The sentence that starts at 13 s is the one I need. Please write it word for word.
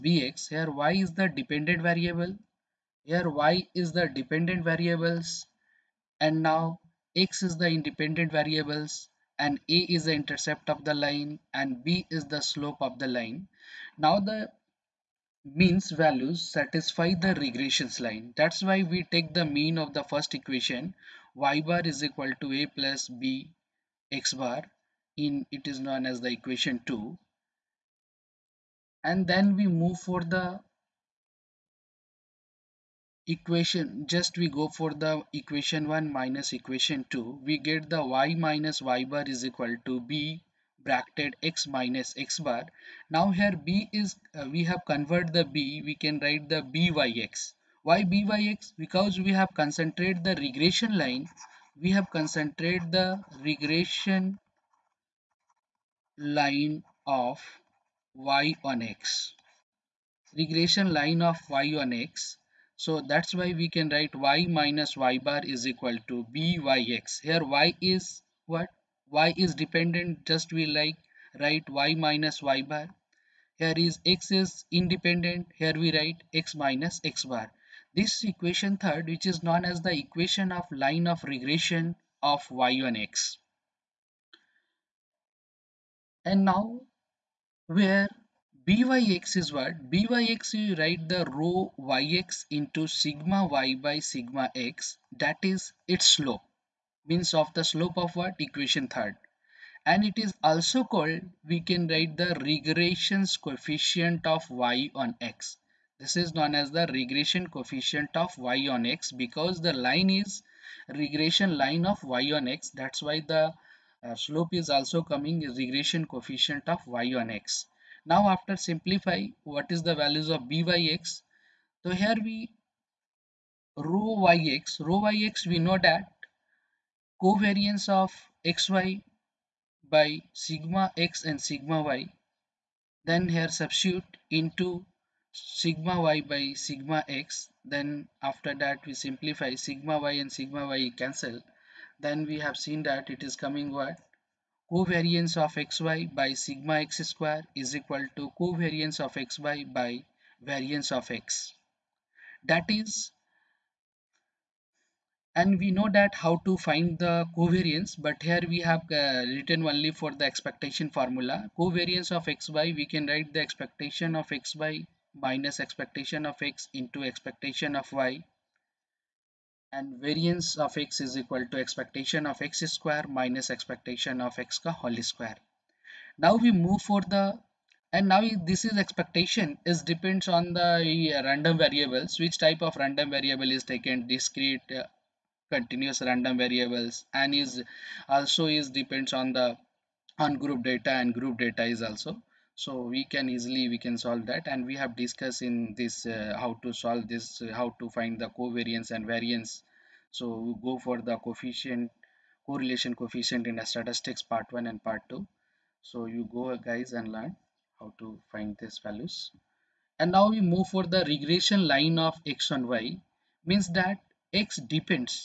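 Now the means values satisfy the regressions line.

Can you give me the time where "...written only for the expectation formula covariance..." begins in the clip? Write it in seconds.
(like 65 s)
159 s.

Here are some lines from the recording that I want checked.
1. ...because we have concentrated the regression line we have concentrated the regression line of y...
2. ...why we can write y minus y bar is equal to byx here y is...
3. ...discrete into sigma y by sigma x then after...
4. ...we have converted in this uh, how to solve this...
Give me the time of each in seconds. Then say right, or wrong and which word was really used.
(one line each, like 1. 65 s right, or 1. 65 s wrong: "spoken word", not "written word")
1. 48 s right
2. 63 s right
3. 133 s wrong: "substitute", not "discrete"
4. 194 s wrong: "discussed", not "converted".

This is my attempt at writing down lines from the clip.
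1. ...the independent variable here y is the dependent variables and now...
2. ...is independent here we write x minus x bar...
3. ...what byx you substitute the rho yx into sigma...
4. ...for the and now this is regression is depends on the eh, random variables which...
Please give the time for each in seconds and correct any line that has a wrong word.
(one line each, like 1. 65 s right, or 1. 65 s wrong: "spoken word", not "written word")
1. 1 s wrong: "dependent", not "independent"
2. 74 s right
3. 89 s wrong: "write", not "substitute"
4. 176 s wrong: "expectation", not "regression".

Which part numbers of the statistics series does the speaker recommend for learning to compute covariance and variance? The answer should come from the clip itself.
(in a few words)
Part 1 and part 2.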